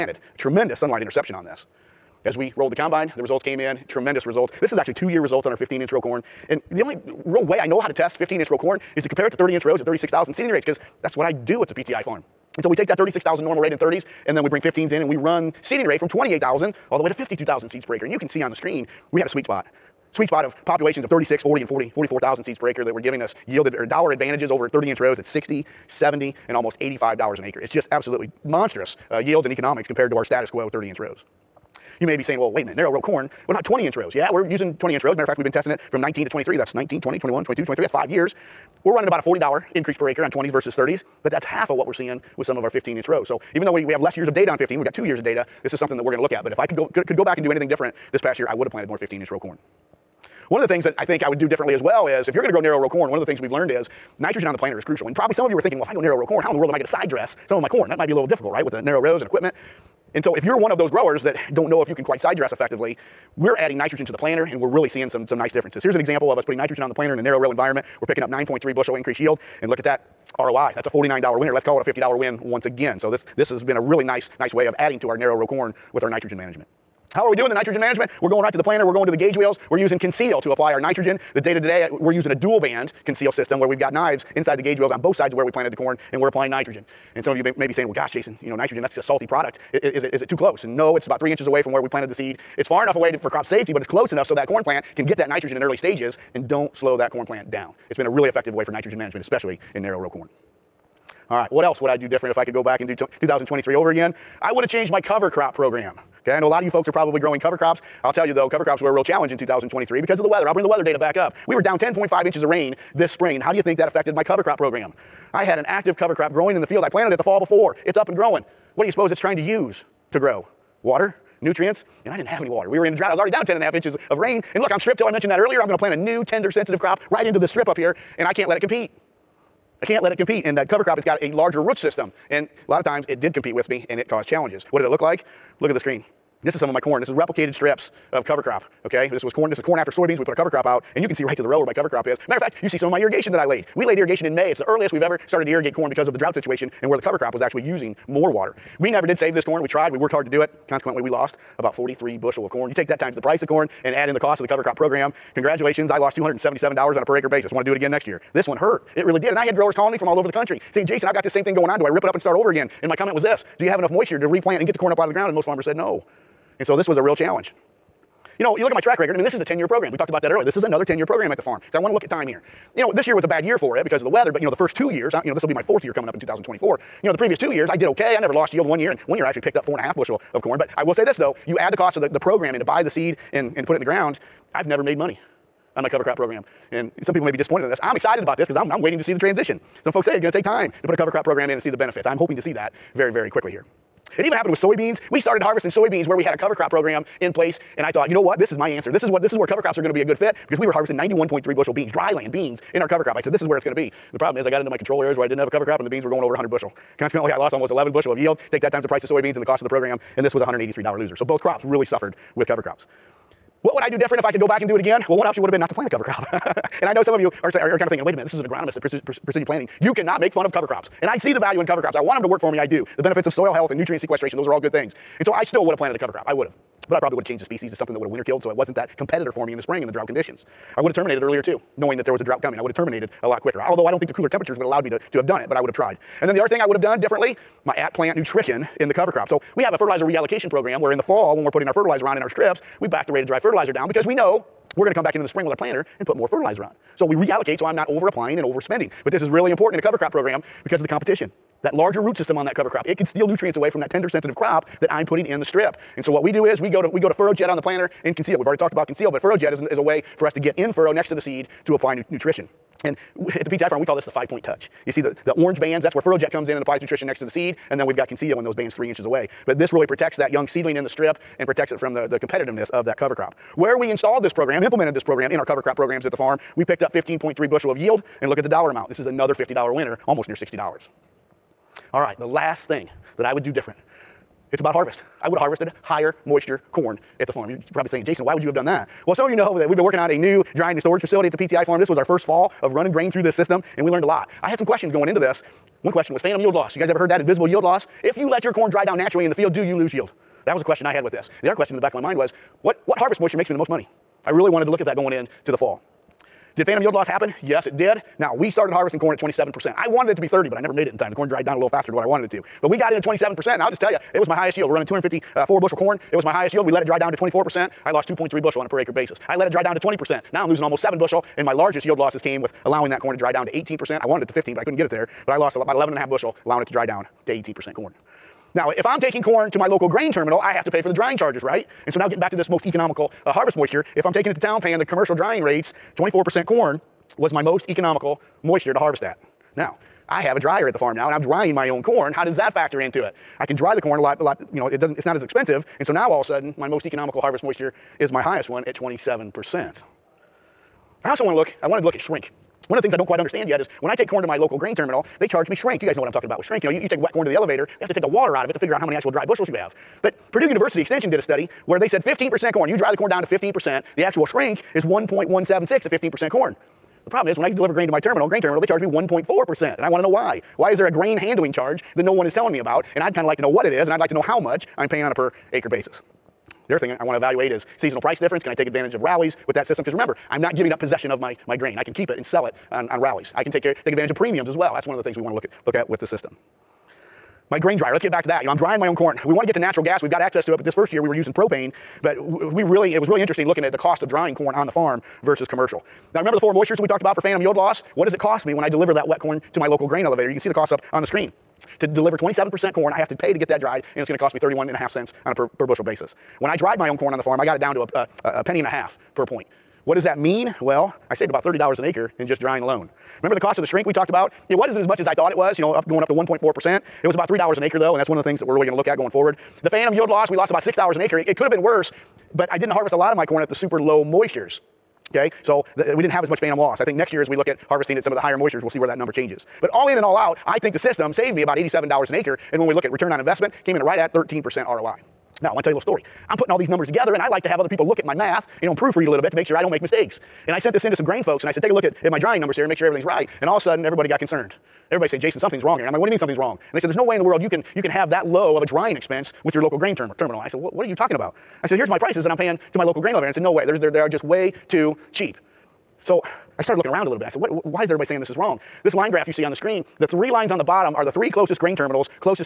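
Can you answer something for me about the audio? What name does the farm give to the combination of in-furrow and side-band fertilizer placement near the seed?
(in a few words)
five point touch.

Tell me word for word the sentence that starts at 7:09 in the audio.
But all in and all out, I think the system saved me about $87 an acre.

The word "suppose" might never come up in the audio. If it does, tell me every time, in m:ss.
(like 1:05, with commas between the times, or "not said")
1:58.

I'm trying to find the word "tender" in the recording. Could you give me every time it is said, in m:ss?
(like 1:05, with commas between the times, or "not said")
2:06, 4:13.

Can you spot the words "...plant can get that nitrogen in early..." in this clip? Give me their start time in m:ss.
1:34.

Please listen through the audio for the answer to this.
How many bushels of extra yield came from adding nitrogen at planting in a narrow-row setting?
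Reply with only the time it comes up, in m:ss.
1:08.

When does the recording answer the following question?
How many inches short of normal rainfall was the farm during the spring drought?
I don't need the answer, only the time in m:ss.
1:51.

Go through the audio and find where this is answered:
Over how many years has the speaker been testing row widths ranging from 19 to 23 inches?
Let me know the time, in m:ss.
0:37.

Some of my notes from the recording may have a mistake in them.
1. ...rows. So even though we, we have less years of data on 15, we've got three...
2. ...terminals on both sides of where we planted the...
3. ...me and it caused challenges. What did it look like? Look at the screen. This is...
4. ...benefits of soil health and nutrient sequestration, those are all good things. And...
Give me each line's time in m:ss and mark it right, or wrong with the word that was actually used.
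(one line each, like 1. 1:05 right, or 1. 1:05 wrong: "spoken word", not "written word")
1. 0:43 wrong: "two", not "three"
2. 1:24 wrong: "wheels", not "terminals"
3. 2:13 right
4. 3:43 right.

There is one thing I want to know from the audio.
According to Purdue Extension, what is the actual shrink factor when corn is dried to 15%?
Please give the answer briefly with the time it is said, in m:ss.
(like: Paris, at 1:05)
1.176, at 6:04.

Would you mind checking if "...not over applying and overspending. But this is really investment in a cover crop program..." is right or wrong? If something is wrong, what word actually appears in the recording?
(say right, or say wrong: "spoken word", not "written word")
wrong: "important", not "investment".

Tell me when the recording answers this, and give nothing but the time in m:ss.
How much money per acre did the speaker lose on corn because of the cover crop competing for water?
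2:36.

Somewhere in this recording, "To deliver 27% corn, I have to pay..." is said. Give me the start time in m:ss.
6:41.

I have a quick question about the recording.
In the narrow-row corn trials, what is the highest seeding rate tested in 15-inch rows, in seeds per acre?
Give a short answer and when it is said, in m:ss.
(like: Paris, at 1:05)
52,000, at 0:17.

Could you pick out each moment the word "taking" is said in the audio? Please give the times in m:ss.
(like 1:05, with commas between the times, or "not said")
5:28, 5:34.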